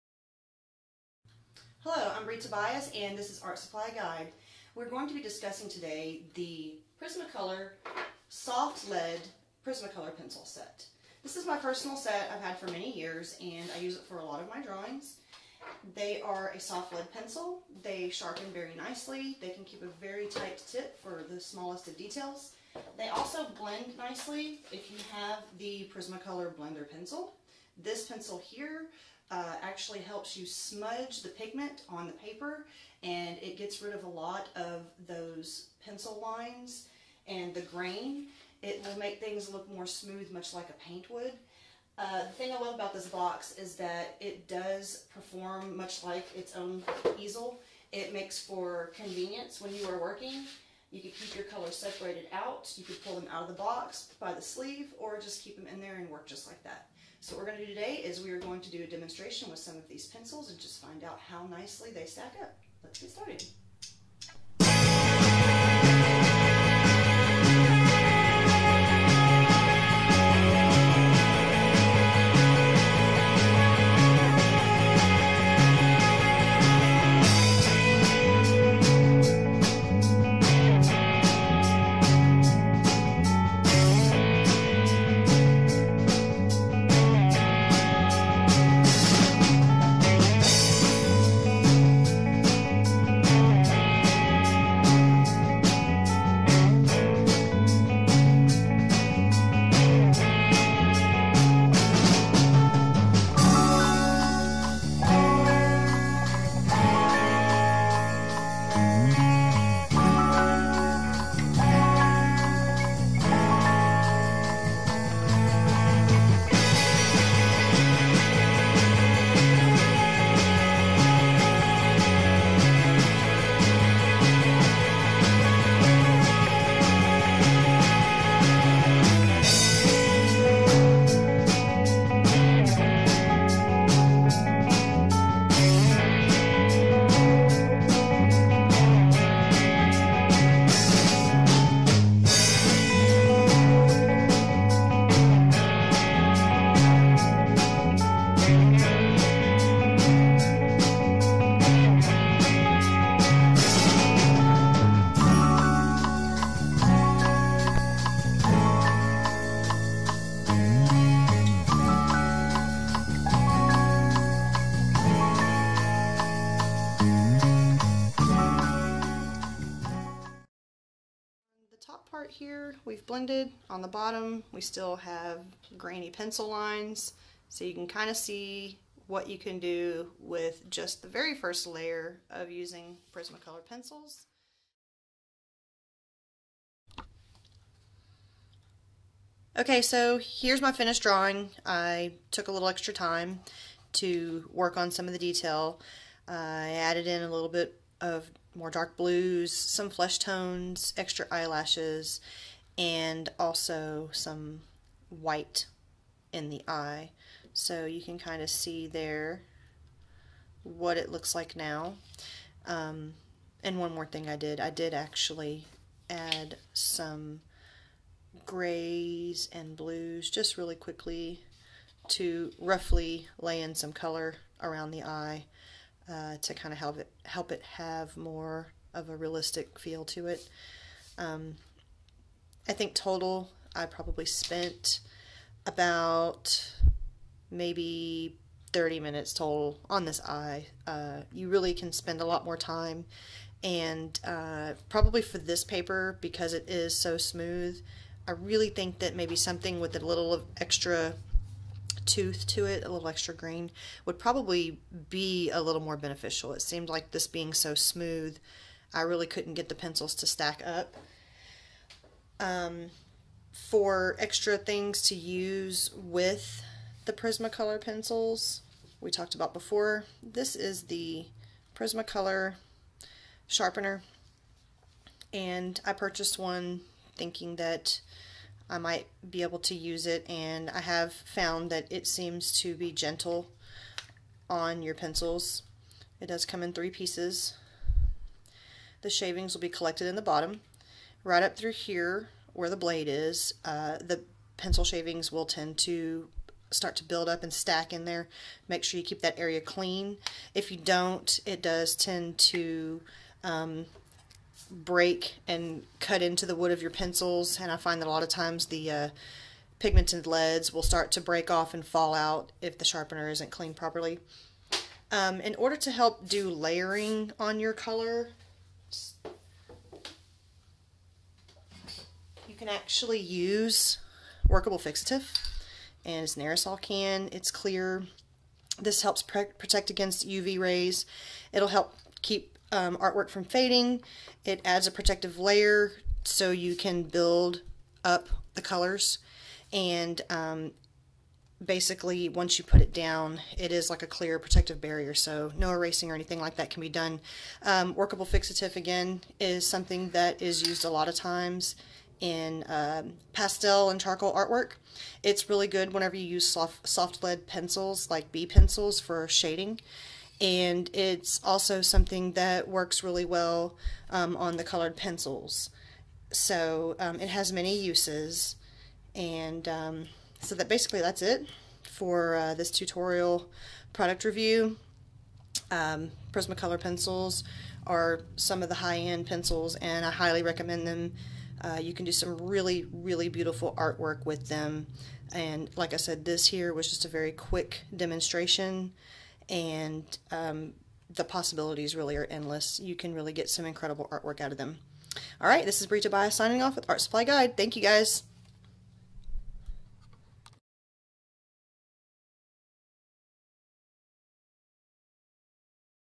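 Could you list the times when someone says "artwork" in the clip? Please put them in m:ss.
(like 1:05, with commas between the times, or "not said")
5:32, 5:54, 6:23, 6:34.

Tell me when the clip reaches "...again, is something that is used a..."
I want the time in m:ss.
5:48.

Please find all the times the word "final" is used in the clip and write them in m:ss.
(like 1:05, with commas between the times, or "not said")
not said.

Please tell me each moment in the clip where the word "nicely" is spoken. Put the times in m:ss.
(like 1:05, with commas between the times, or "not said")
0:18, 0:23, 1:01.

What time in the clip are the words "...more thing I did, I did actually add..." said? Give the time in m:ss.
3:33.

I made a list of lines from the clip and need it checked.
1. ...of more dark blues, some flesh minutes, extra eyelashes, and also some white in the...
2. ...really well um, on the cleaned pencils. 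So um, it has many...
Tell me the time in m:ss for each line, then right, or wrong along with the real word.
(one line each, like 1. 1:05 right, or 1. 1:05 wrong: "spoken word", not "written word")
1. 3:17 wrong: "tones", not "minutes"
2. 6:03 wrong: "colored", not "cleaned".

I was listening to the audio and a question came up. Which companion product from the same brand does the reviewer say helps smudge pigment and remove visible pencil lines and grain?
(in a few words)
Prismacolor Blender Pencil.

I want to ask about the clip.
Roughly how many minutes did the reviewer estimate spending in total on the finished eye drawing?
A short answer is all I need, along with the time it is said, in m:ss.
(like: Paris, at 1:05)
30, at 3:58.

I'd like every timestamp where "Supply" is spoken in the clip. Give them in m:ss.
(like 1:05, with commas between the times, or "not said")
0:03, 6:37.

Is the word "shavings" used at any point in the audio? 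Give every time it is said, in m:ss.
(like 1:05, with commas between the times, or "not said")
4:49, 4:54.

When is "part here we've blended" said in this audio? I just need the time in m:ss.
2:52.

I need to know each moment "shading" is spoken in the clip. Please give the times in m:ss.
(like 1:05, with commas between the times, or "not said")
5:59.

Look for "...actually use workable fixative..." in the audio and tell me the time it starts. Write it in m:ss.
5:22.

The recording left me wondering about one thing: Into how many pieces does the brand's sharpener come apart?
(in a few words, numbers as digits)
3.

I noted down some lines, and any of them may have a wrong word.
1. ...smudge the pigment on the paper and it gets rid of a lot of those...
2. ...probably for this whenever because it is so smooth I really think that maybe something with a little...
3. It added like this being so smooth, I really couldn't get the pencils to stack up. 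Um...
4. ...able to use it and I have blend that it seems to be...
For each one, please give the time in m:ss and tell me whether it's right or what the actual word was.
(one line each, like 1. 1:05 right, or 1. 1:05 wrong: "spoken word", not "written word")
1. 0:30 right
2. 4:04 wrong: "paper", not "whenever"
3. 4:16 wrong: "seemed", not "added"
4. 4:39 wrong: "found", not "blend".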